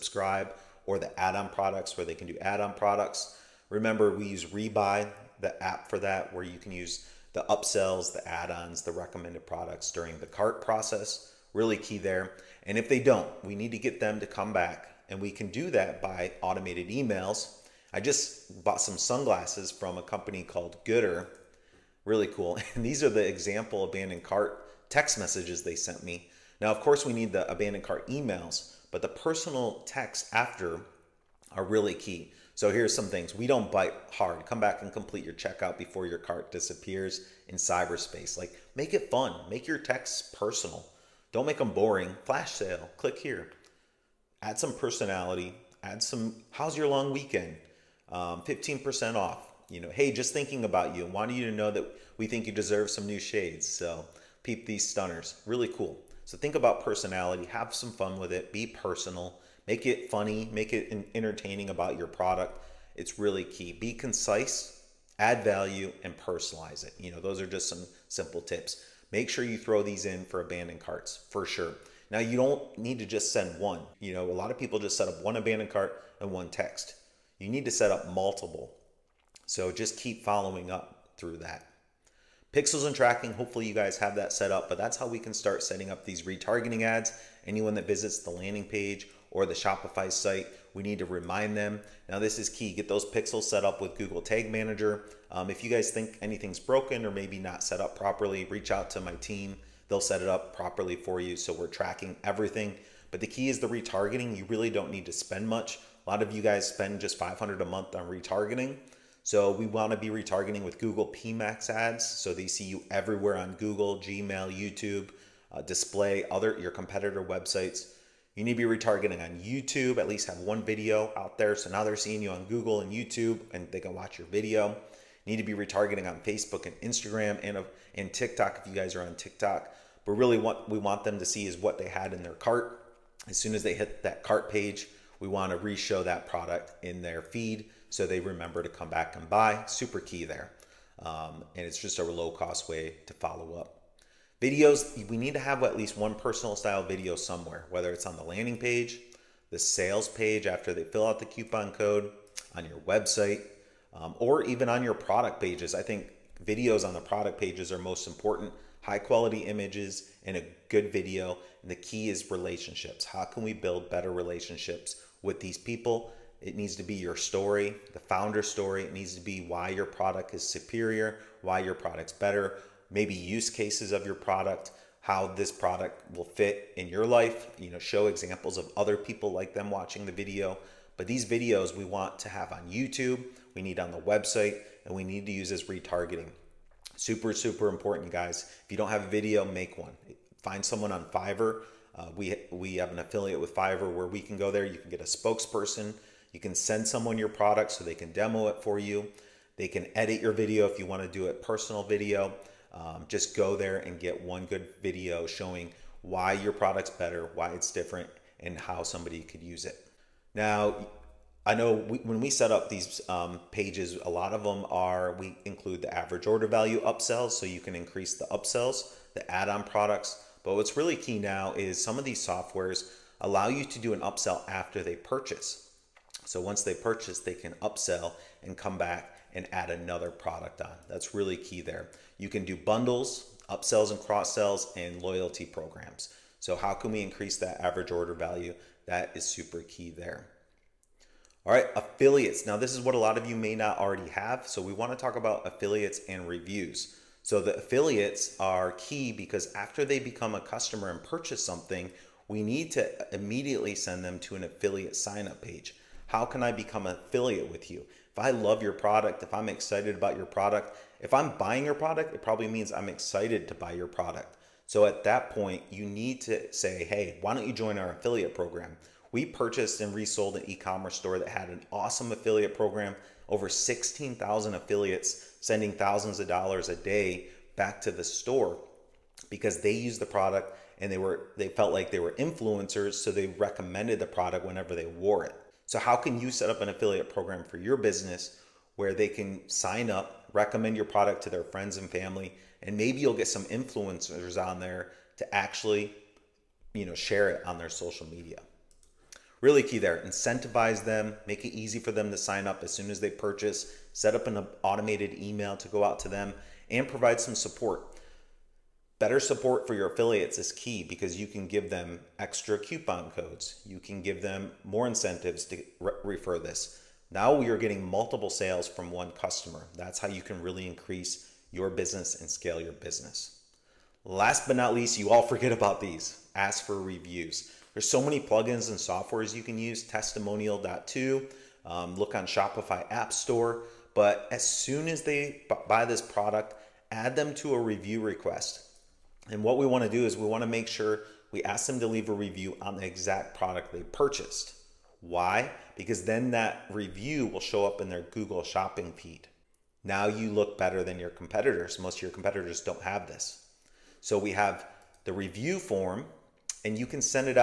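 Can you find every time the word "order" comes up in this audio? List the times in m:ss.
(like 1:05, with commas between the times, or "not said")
3:36, 3:57.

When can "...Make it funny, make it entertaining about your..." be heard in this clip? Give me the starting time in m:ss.
0:59.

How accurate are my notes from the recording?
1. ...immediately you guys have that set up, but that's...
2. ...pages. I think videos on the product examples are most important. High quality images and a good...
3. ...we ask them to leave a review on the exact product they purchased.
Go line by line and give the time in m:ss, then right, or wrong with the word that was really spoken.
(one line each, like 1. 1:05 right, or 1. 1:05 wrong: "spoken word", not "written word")
1. 1:23 wrong: "hopefully", not "immediately"
2. 2:35 wrong: "pages", not "examples"
3. 5:41 right.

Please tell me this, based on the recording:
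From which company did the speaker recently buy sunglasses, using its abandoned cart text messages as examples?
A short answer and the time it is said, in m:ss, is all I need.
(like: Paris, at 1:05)
Goodr, at 0:20.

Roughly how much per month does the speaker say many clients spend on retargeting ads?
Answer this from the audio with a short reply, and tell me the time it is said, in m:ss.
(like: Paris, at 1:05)
500, at 1:47.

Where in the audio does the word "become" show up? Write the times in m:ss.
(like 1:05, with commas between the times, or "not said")
4:09, 4:16.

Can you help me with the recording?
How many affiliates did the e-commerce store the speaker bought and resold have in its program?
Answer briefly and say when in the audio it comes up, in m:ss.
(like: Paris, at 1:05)
16,000, at 4:33.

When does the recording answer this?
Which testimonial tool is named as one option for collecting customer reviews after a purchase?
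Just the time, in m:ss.
5:29.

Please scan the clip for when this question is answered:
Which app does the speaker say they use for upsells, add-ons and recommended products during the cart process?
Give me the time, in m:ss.
0:04.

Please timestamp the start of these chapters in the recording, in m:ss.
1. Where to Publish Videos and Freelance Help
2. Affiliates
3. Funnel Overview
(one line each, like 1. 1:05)
1. 3:05
2. 4:05
3. 1:30.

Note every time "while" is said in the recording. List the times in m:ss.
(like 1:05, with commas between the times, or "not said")
not said.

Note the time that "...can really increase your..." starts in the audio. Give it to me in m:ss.
5:20.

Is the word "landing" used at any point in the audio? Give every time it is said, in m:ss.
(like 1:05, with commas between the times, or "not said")
1:28, 2:28.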